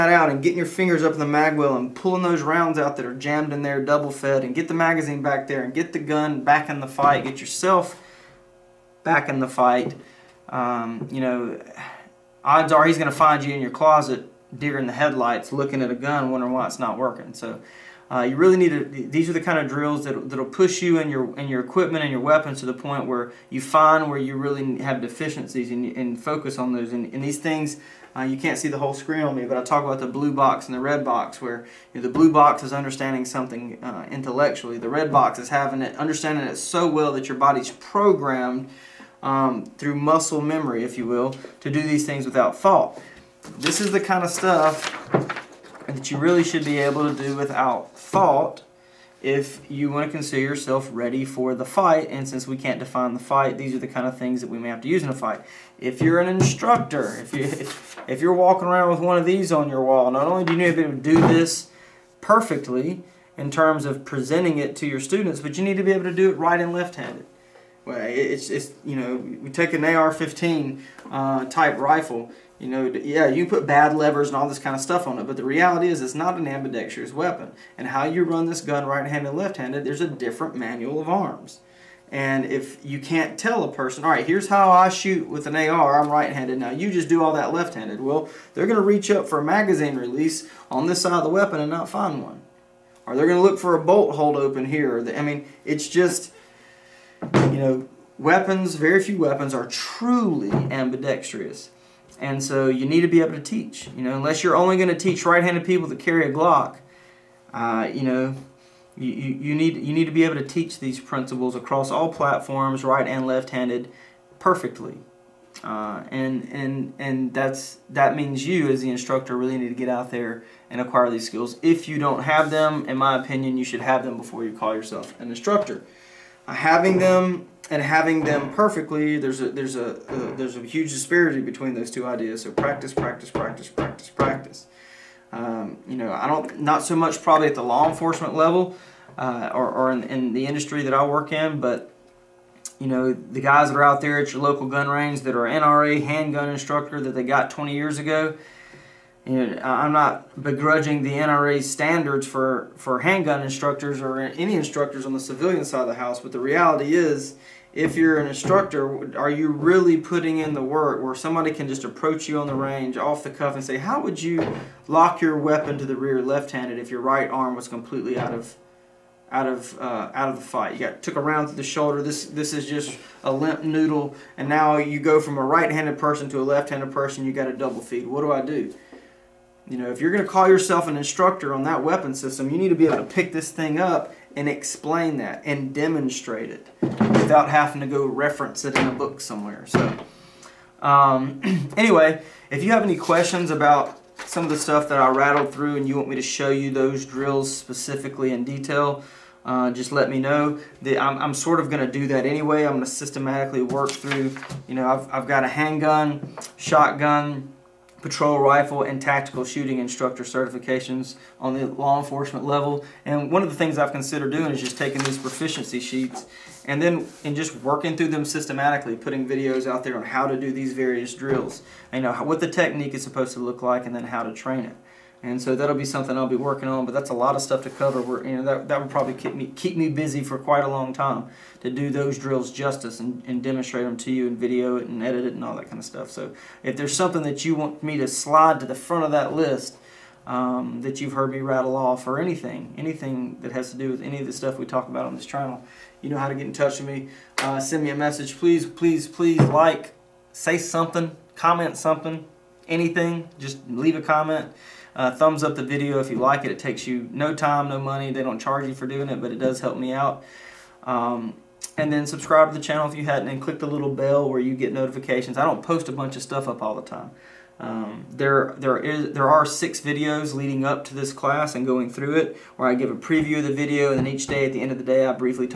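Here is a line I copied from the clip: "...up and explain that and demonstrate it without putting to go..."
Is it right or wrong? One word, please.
wrong.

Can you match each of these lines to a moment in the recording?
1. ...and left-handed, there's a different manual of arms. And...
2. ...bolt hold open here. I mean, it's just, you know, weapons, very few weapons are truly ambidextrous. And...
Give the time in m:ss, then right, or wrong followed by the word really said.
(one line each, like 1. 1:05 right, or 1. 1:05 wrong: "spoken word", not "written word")
1. 1:19 right
2. 1:33 right.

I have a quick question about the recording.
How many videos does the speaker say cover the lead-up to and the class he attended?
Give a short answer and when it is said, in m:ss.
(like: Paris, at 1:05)
6, at 4:29.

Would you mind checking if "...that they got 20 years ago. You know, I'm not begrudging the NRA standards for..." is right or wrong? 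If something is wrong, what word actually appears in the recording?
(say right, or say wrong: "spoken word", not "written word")
right.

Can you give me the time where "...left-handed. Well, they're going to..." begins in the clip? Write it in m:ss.
1:27.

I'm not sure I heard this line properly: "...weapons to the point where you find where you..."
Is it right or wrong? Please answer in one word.
right.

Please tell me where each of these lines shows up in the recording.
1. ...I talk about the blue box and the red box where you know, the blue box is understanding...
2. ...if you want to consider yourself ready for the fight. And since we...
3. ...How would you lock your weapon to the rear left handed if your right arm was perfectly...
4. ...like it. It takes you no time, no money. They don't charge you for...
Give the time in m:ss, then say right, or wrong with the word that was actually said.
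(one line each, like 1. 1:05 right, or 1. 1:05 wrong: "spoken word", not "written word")
1. 0:29 right
2. 0:49 right
3. 2:43 wrong: "completely", not "perfectly"
4. 4:16 right.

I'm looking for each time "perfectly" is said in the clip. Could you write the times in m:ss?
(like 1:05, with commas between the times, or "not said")
1:02, 1:54, 2:08.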